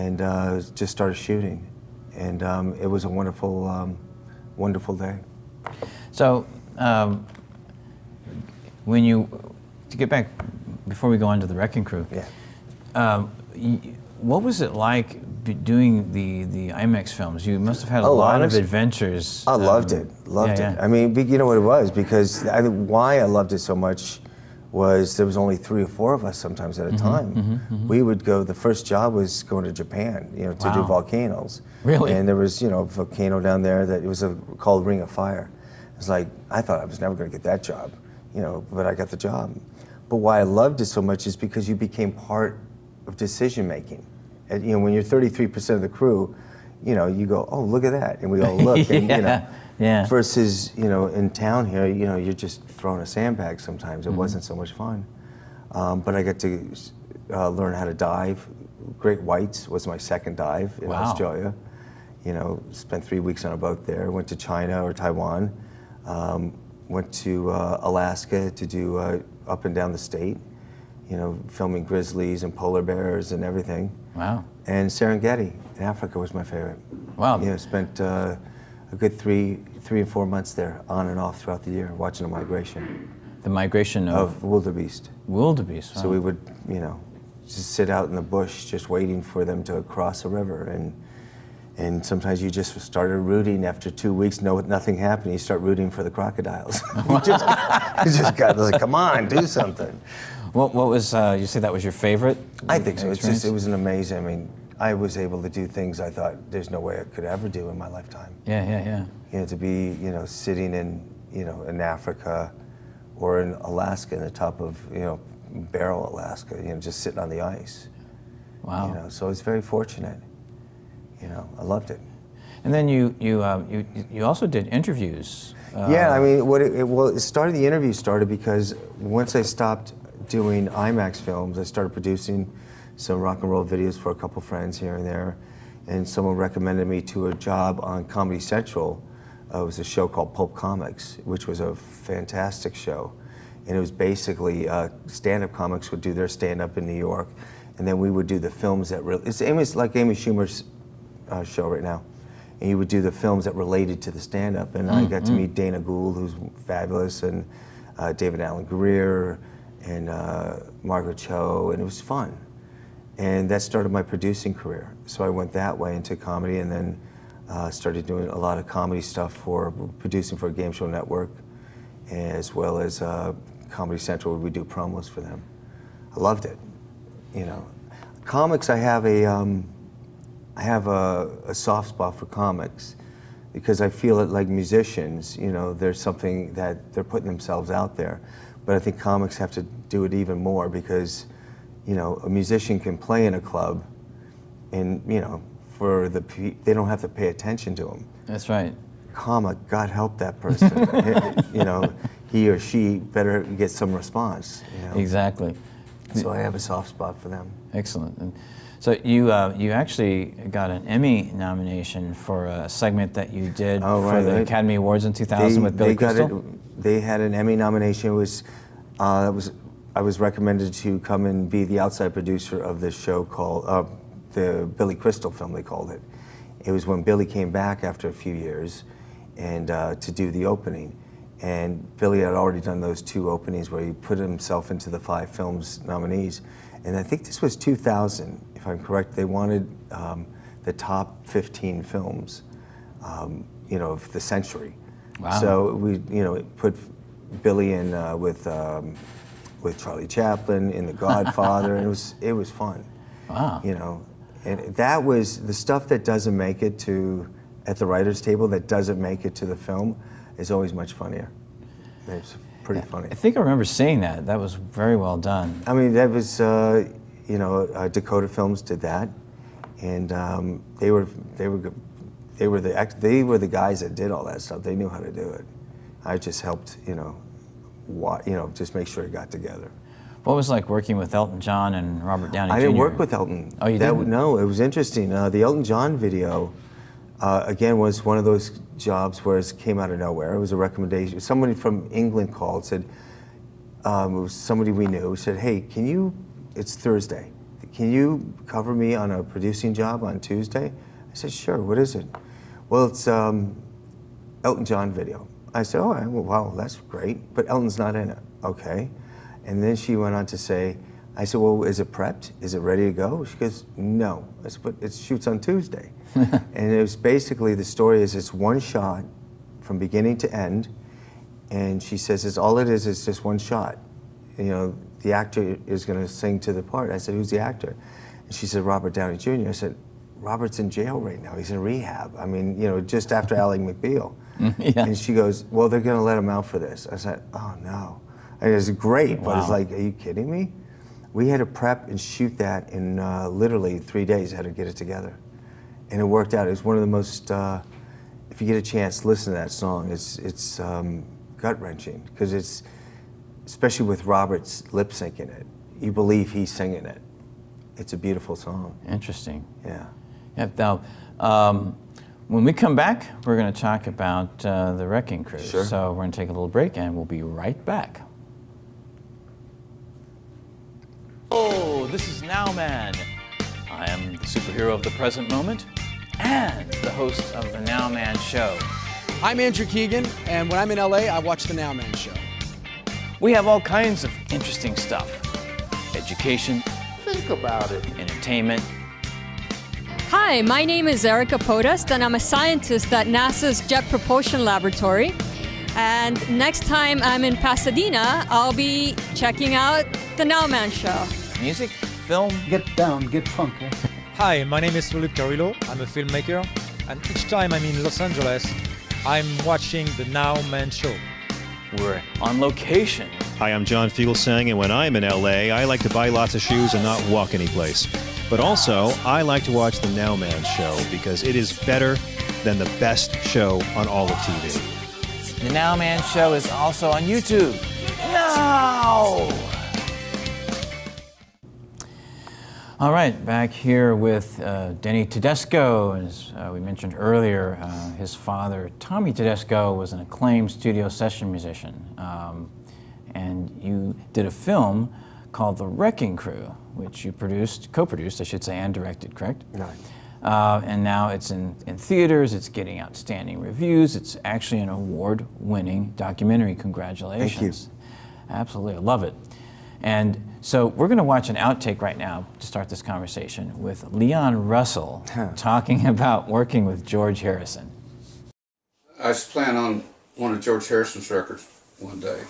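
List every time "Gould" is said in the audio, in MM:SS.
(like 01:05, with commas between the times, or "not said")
02:35.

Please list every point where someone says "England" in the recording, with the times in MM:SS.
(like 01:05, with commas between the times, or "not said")
04:51.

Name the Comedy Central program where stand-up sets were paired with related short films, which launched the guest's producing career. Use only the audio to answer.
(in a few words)
Pulp Comics.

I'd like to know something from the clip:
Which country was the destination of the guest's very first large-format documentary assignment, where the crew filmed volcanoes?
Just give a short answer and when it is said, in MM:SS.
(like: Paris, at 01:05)
Japan, at 00:29.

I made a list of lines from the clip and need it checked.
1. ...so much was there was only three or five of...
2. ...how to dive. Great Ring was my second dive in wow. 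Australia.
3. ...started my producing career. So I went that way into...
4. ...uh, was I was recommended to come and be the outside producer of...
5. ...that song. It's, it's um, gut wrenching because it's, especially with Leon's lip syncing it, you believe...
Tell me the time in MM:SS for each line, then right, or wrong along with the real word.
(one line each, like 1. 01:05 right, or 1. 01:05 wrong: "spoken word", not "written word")
1. 00:23 wrong: "four", not "five"
2. 00:57 wrong: "Whites", not "Ring"
3. 02:43 right
4. 03:38 right
5. 05:49 wrong: "Robert", not "Leon".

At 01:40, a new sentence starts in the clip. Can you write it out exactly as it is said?
What, what was, uh, you say that was your favorite?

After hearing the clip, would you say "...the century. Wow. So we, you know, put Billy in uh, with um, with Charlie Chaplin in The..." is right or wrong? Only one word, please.
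right.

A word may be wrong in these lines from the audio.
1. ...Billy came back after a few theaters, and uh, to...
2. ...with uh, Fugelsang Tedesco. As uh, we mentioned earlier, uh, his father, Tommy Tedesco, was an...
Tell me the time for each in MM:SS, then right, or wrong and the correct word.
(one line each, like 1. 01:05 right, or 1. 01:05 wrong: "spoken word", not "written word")
1. 03:47 wrong: "years", not "theaters"
2. 07:13 wrong: "Denny", not "Fugelsang".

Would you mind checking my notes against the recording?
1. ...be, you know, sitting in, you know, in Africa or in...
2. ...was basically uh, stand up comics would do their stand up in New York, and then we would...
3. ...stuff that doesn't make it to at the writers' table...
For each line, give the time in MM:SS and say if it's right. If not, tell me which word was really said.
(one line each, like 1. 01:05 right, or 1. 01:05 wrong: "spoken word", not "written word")
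1. 01:49 right
2. 02:23 right
3. 04:15 right.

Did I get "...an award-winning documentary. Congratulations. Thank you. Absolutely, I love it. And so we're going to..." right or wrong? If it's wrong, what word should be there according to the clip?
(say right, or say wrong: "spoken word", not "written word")
right.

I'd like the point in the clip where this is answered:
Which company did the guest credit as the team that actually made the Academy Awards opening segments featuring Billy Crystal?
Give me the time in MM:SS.
04:27.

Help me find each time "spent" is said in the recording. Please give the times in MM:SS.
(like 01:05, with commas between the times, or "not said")
01:02, 01:17.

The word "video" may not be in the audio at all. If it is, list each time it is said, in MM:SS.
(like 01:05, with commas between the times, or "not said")
02:13, 04:45, 05:04.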